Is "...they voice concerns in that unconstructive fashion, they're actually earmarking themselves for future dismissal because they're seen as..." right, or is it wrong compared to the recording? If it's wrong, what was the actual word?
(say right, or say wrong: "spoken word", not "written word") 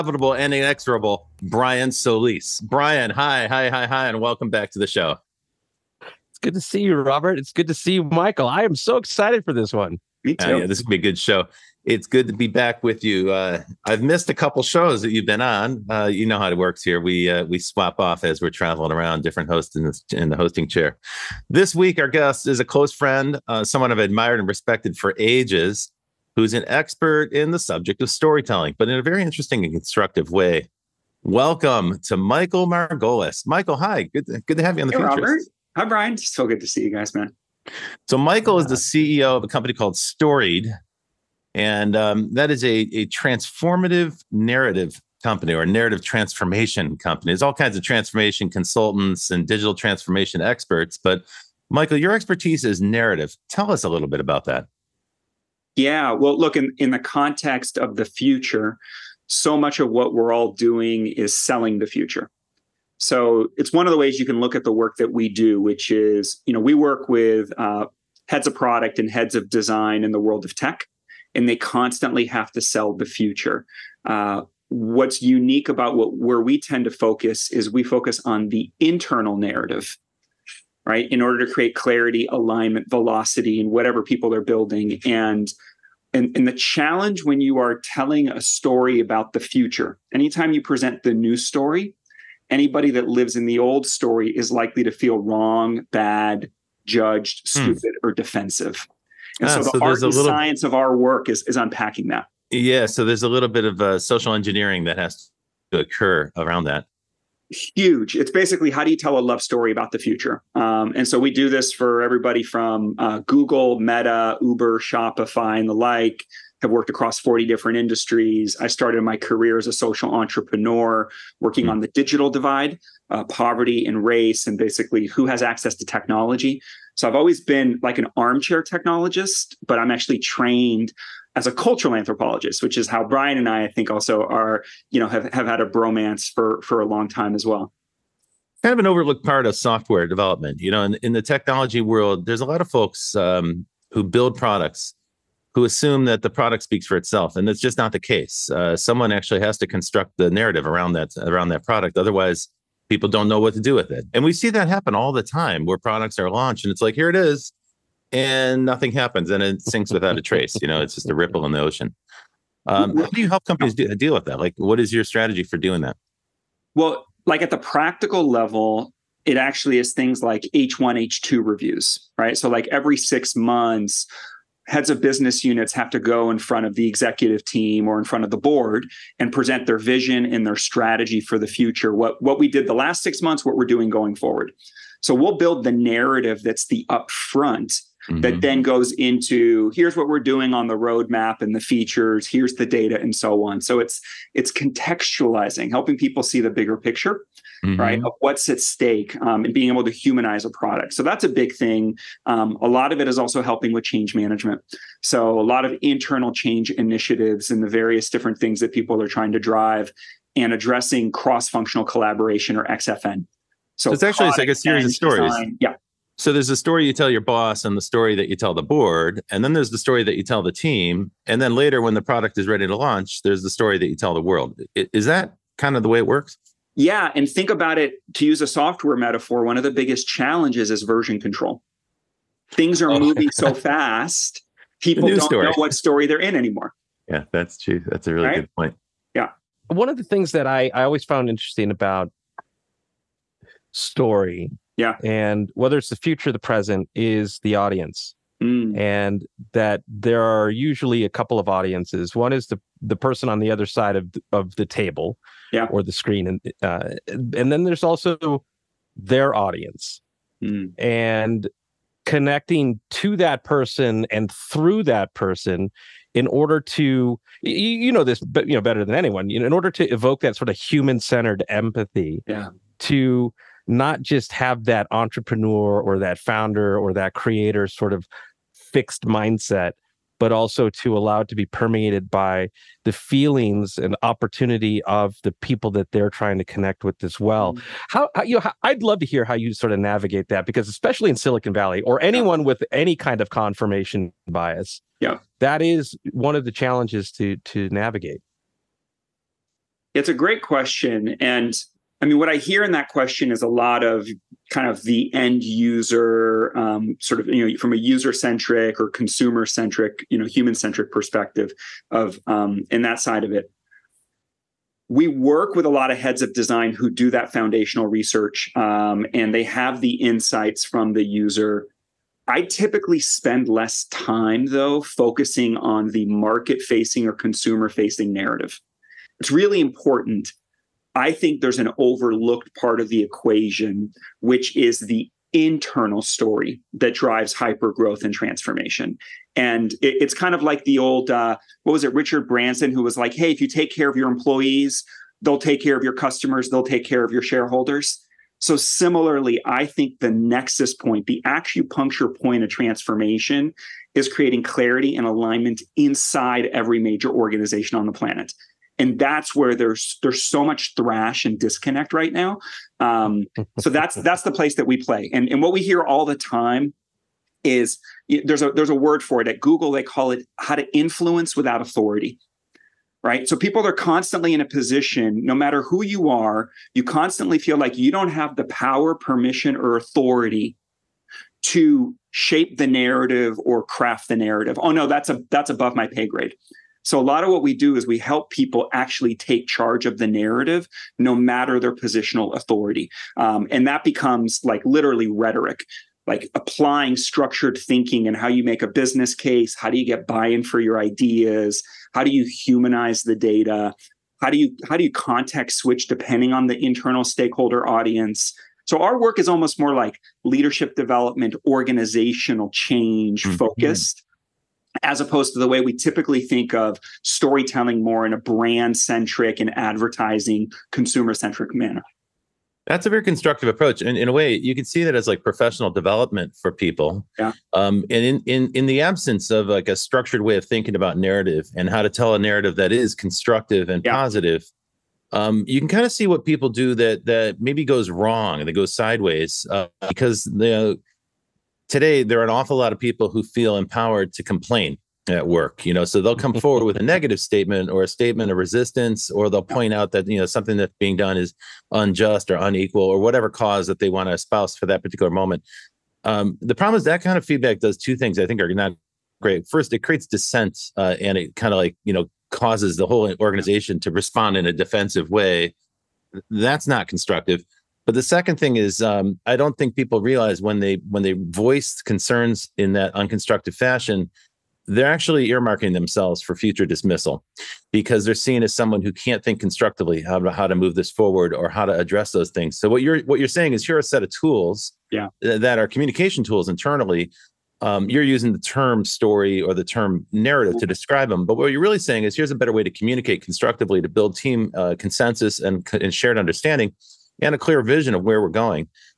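right.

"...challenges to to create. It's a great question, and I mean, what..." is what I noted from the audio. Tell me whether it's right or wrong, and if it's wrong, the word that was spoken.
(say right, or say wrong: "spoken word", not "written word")
wrong: "navigate", not "create".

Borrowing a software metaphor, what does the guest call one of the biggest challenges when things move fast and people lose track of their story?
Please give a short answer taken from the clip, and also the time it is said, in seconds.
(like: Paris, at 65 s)
Version control, at 230 s.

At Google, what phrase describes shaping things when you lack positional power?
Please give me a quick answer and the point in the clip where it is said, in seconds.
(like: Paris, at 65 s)
Influence without authority, at 370 s.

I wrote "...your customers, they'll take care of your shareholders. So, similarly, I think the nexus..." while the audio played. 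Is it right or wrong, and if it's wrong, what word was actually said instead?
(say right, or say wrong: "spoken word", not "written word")
right.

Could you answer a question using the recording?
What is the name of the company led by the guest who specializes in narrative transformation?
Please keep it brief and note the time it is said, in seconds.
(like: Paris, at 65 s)
Storied, at 39 s.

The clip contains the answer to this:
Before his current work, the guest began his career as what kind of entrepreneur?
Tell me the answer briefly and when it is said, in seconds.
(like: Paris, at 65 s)
Social entrepreneur, at 119 s.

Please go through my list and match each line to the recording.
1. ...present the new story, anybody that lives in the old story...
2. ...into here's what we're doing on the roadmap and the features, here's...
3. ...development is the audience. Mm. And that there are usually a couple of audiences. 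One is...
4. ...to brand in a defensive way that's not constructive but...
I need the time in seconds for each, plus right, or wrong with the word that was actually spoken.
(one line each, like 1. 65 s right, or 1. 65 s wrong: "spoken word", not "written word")
1. 90 s right
2. 188 s right
3. 246 s wrong: "present", not "development"
4. 463 s wrong: "respond", not "brand".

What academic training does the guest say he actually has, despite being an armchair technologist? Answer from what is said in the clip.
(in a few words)
Cultural anthropologist.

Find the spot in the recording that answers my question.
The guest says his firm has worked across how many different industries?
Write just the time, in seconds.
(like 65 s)
117 s.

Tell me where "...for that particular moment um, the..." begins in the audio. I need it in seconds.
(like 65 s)
454 s.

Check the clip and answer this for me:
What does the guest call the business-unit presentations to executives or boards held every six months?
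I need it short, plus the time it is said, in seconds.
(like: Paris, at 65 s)
H1 H2 reviews, at 170 s.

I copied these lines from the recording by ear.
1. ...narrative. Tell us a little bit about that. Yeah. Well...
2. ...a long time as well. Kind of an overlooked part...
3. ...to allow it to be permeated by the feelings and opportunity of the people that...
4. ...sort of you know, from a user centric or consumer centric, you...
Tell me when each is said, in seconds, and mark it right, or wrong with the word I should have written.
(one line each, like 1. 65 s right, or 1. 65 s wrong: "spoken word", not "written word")
1. 52 s right
2. 136 s right
3. 280 s right
4. 306 s right.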